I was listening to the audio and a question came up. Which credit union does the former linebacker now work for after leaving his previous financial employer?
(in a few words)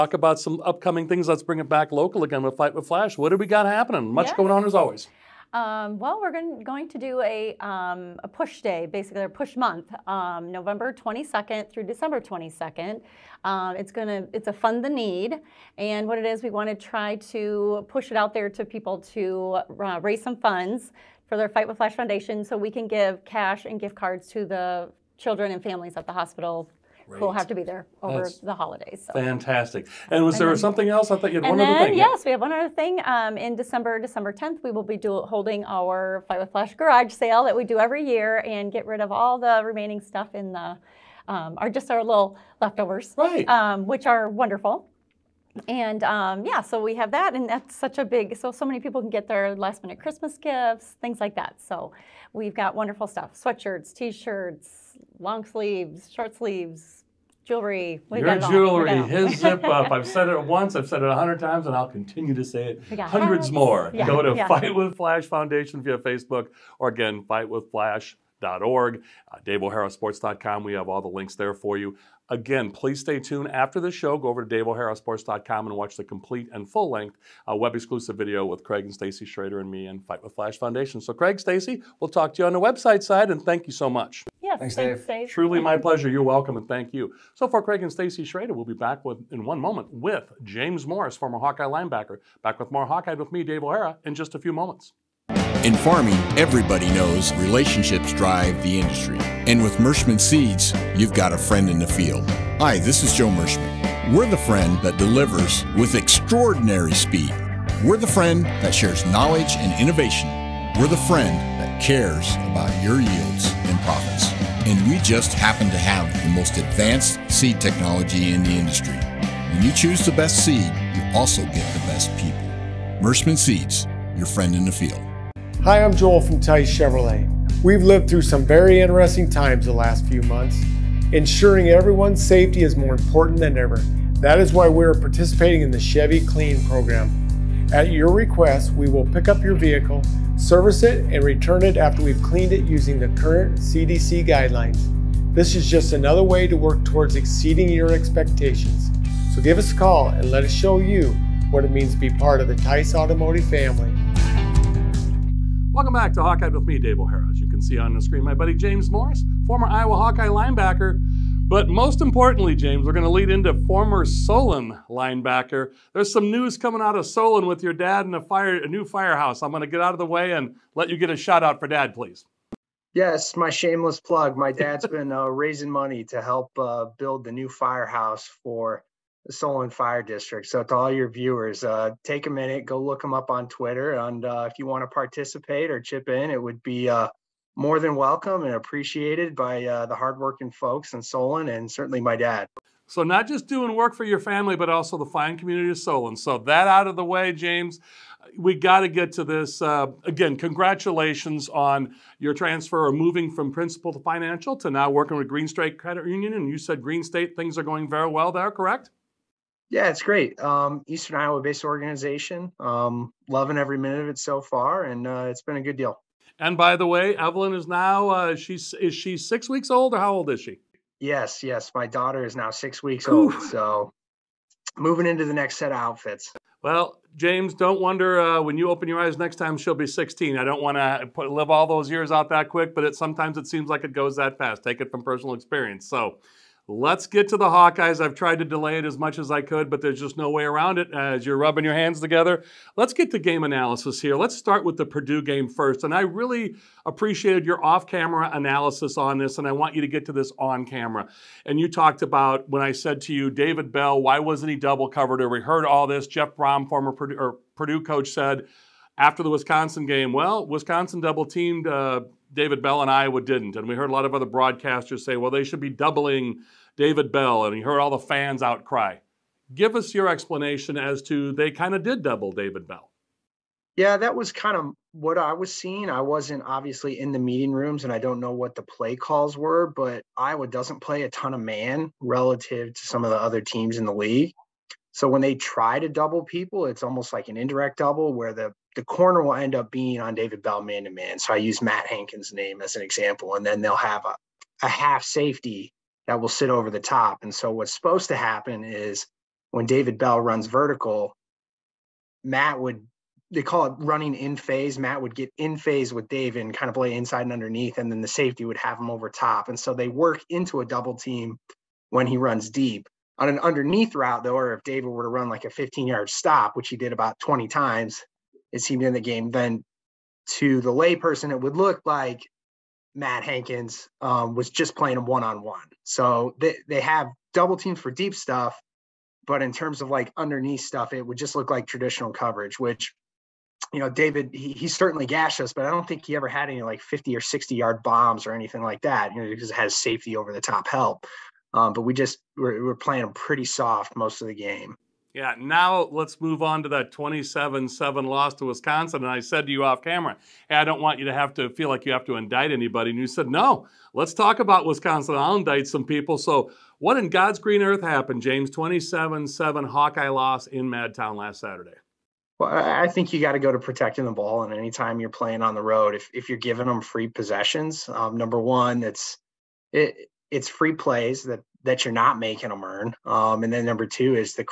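Green State Credit Union.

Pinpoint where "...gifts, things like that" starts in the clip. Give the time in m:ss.
0:50.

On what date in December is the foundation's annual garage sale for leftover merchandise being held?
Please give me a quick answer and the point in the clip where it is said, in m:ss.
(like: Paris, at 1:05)
December 10th, at 0:33.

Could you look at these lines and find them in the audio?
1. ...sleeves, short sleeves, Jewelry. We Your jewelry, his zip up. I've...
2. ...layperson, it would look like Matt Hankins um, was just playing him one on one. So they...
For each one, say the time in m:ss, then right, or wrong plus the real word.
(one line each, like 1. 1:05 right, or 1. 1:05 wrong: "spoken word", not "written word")
1. 0:55 right
2. 5:20 right.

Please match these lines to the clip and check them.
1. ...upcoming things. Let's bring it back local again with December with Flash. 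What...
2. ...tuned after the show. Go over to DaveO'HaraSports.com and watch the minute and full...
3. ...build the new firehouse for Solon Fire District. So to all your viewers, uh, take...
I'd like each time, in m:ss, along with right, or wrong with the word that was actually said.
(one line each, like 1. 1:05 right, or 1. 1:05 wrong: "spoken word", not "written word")
1. 0:00 wrong: "Fight", not "December"
2. 1:13 wrong: "complete", not "minute"
3. 2:56 right.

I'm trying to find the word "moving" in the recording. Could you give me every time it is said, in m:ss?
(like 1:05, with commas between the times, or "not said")
3:22, 3:44.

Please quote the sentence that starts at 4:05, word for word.
And I really appreciated your off camera analysis on this, and I want you to get to this on camera.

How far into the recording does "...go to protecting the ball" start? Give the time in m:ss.
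6:03.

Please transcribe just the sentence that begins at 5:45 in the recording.
Yeah, now let's move on to that 27 7 loss to Wisconsin.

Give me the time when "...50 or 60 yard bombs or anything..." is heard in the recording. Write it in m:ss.
5:36.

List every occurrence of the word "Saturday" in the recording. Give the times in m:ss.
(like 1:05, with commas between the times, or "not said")
6:01.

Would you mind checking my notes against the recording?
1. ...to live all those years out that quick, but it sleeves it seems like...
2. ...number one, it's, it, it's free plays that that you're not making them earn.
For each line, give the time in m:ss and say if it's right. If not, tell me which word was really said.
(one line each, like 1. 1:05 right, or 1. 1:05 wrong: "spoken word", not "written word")
1. 3:50 wrong: "sometimes", not "sleeves"
2. 6:08 right.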